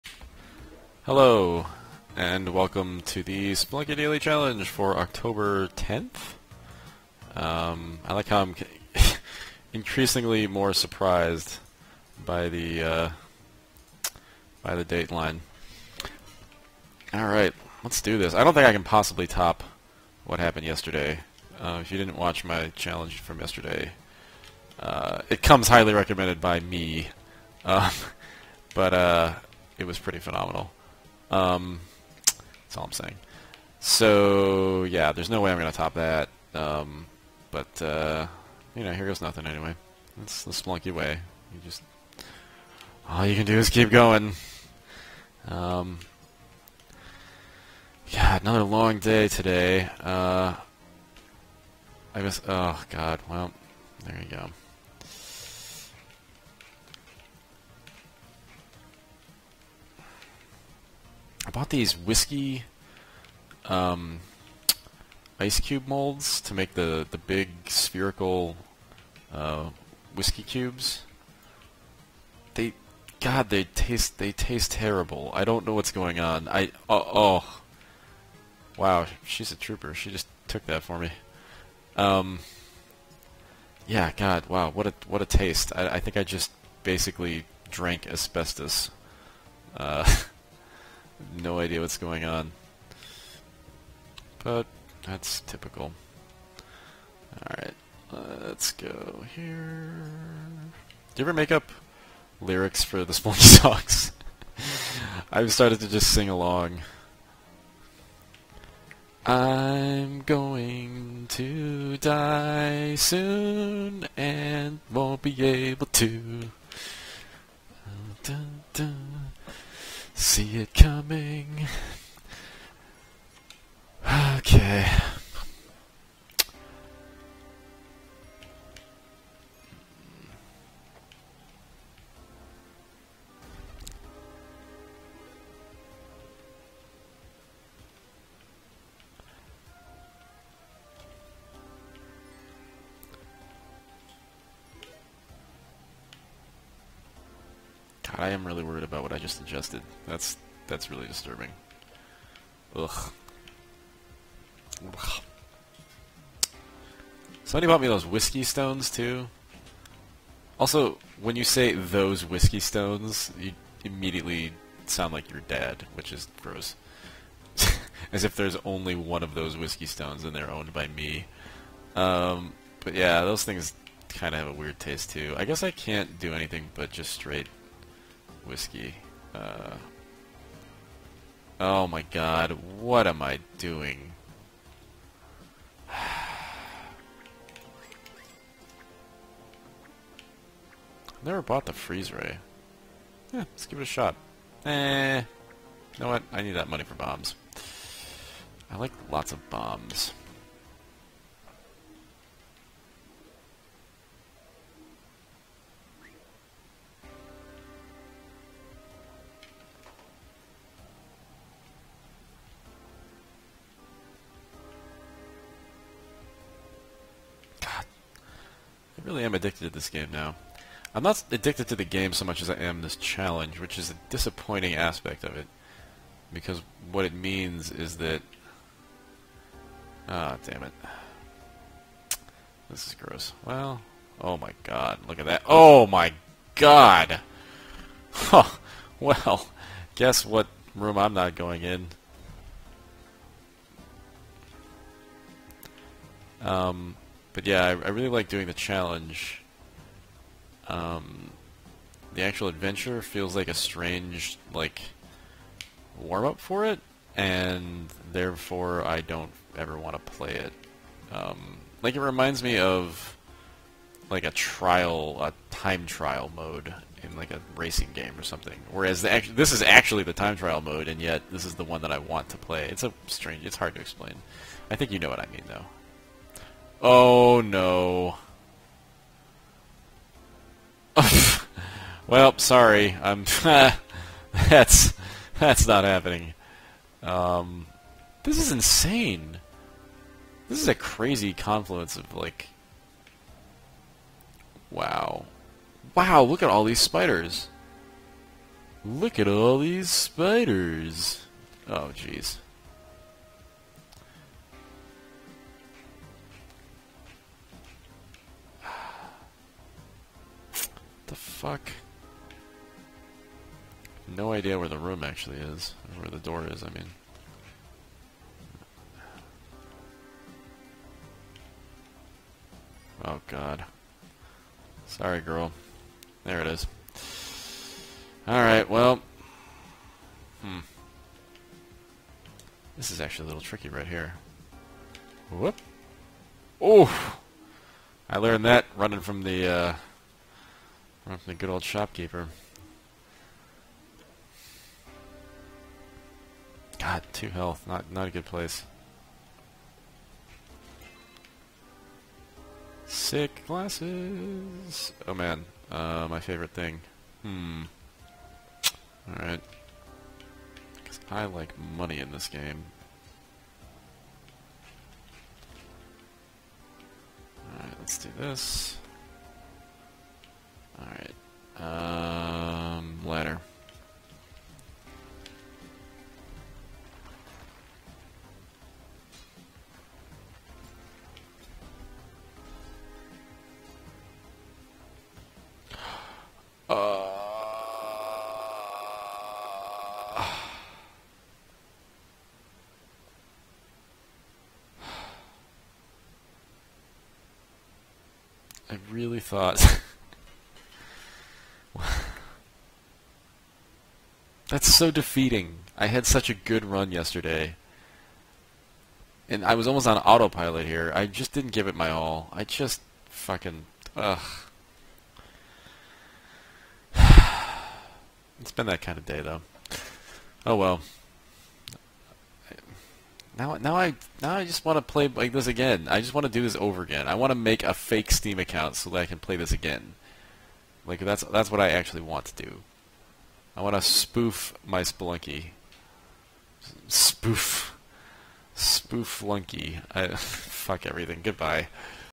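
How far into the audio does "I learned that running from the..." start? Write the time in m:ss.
5:38.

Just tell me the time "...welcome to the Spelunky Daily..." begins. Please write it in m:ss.
0:02.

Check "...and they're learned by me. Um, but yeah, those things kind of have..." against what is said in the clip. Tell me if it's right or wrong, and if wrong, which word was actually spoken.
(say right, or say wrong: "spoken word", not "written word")
wrong: "owned", not "learned".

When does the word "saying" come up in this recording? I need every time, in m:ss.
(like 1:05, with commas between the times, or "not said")
0:32.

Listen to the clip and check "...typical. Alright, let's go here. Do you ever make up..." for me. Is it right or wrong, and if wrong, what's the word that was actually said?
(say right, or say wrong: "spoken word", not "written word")
right.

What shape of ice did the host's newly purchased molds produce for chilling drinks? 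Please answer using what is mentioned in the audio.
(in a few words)
spherical.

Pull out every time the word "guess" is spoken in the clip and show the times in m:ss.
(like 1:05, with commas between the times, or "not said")
0:52, 2:55, 3:59.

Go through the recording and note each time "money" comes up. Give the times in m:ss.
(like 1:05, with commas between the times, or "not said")
3:16, 6:01.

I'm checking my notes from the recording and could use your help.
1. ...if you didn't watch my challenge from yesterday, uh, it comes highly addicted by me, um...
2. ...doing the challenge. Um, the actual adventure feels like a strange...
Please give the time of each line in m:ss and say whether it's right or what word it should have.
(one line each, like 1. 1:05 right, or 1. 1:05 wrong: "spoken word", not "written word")
1. 0:21 wrong: "recommended", not "addicted"
2. 4:08 right.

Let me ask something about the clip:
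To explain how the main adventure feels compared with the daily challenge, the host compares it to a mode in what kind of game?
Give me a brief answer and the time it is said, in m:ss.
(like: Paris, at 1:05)
racing game, at 4:27.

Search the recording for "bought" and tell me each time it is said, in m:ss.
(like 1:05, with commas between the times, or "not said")
1:01, 2:37, 3:11.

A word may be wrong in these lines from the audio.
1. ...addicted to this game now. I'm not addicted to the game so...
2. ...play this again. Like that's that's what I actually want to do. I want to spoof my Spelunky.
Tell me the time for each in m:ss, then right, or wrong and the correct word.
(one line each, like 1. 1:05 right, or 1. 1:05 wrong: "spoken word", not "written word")
1. 3:39 right
2. 7:09 right.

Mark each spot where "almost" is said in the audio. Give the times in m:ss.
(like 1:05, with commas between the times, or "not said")
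6:49.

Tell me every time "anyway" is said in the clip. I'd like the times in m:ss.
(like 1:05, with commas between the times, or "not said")
0:39.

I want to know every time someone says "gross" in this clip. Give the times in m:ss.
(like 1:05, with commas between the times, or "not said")
2:46, 3:52.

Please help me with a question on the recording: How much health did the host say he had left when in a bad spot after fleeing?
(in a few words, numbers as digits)
2.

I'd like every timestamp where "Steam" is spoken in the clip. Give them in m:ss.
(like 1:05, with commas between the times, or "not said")
7:08.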